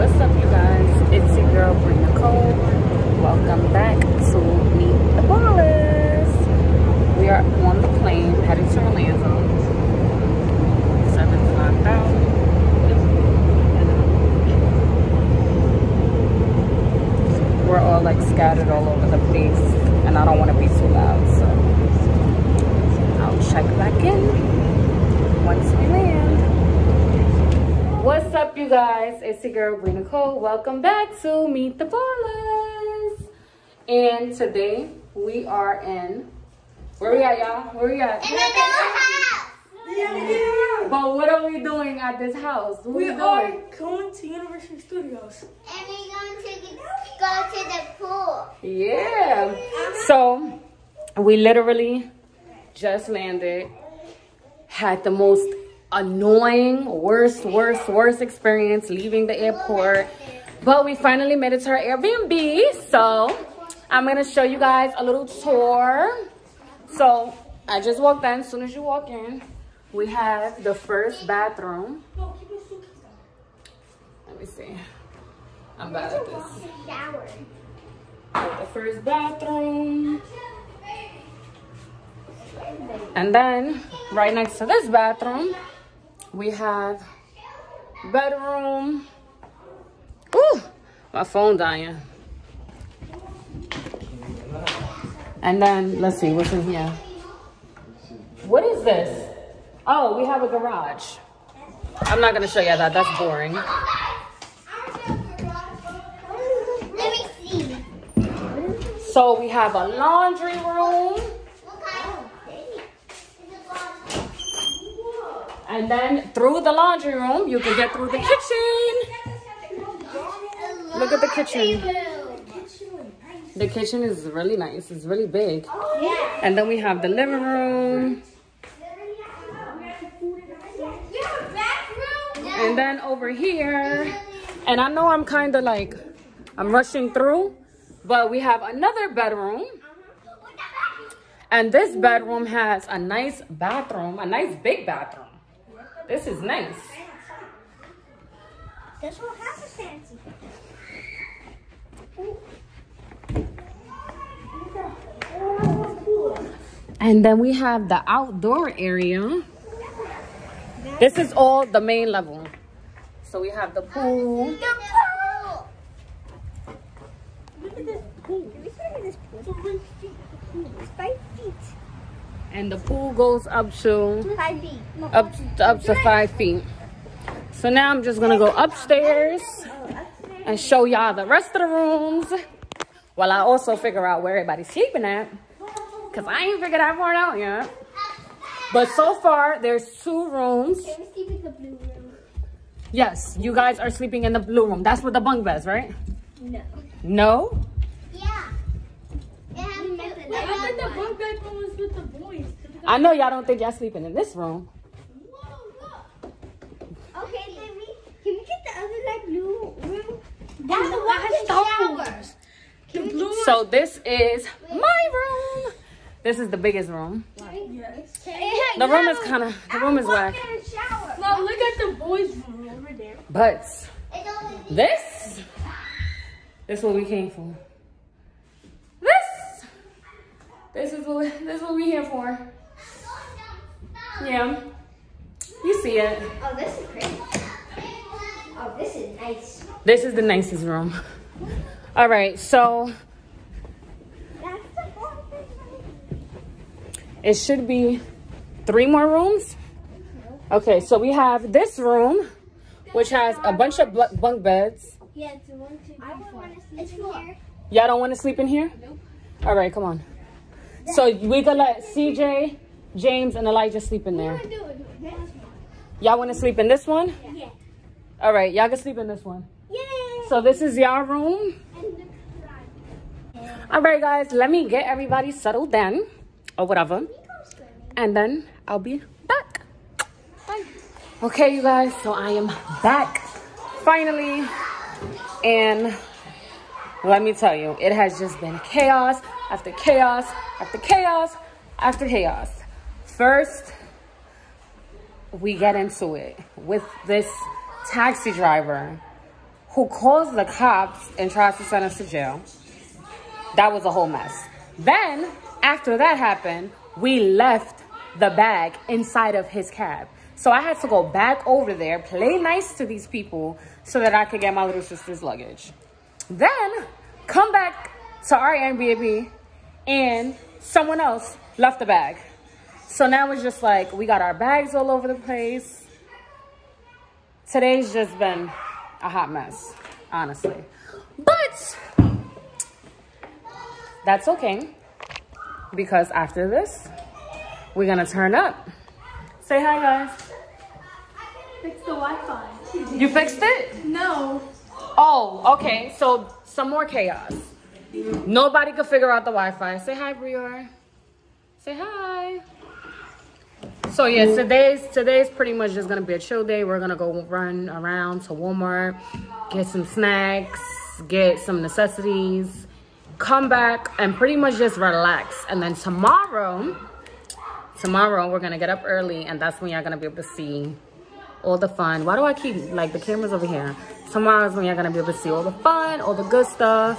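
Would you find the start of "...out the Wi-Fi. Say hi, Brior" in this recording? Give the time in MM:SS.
05:49.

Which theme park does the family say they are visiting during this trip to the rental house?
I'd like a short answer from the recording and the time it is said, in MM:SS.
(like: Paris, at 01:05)
Universal Studios, at 00:44.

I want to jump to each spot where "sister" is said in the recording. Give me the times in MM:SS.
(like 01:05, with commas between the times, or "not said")
05:14.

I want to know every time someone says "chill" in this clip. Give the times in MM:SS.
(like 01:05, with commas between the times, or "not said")
05:56.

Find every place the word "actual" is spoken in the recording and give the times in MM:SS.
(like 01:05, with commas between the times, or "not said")
not said.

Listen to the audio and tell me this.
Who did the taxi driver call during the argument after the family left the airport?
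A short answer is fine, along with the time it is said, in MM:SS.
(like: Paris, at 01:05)
the cops, at 05:00.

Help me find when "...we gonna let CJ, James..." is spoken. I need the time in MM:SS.
04:21.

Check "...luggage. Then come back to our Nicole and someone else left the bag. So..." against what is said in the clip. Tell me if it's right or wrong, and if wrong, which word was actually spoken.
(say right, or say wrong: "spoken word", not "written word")
wrong: "Airbnb", not "Nicole".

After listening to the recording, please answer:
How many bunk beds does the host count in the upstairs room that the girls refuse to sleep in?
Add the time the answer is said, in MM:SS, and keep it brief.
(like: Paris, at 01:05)
4, at 04:17.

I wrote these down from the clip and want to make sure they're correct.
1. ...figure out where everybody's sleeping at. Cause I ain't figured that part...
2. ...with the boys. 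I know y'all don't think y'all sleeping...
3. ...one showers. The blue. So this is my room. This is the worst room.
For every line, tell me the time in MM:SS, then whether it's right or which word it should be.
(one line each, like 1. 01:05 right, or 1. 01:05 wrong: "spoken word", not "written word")
1. 03:03 right
2. 03:21 right
3. 03:30 wrong: "biggest", not "worst".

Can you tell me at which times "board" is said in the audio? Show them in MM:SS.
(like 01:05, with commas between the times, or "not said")
not said.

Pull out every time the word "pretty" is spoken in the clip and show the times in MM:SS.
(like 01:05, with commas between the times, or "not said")
05:55, 06:04.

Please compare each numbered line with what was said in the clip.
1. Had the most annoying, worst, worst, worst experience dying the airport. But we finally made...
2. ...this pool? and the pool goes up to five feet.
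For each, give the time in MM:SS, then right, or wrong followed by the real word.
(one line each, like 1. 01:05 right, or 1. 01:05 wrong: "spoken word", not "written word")
1. 00:54 wrong: "leaving", not "dying"
2. 02:49 right.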